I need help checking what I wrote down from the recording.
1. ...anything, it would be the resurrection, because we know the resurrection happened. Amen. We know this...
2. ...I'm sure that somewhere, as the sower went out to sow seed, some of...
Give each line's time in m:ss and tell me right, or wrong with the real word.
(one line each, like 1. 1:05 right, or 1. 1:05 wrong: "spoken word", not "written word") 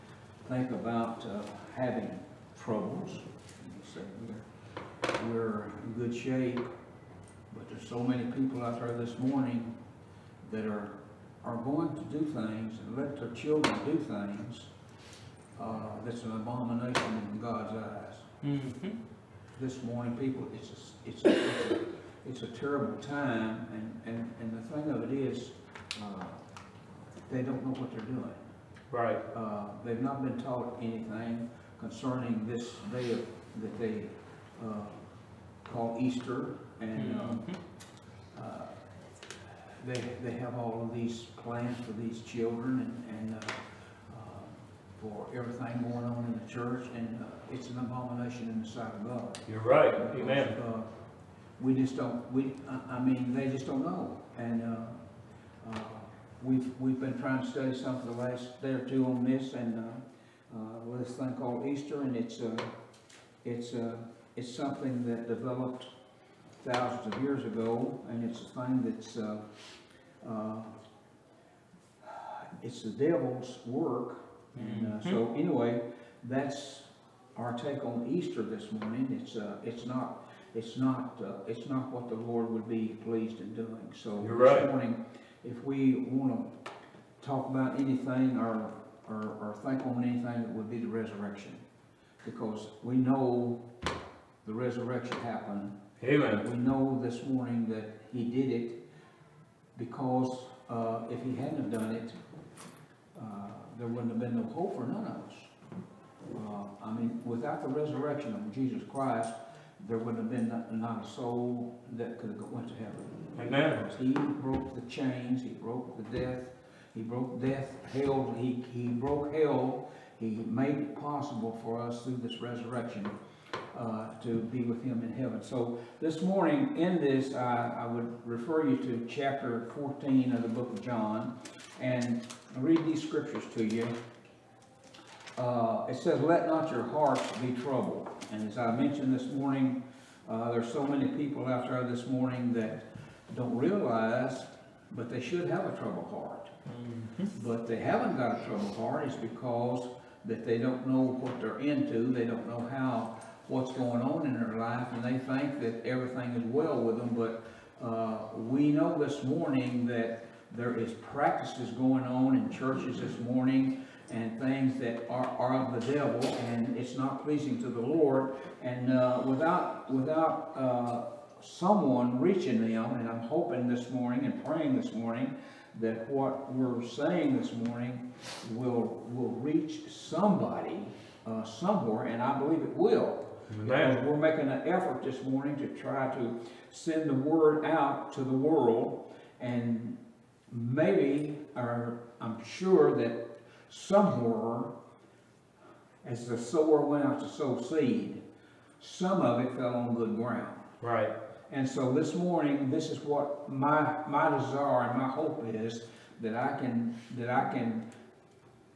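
1. 1:30 right
2. 3:12 right.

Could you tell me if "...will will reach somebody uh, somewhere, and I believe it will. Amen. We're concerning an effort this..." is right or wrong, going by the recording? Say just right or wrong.
wrong.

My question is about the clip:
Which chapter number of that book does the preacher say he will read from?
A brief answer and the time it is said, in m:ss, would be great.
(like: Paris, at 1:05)
14, at 2:09.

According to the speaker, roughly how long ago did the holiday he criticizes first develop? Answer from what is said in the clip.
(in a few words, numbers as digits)
thousands of years ago.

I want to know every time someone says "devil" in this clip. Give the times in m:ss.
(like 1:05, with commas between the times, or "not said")
1:12, 2:45.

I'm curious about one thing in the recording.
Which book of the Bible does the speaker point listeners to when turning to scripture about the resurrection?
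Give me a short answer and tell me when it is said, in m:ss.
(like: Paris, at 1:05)
John, at 2:10.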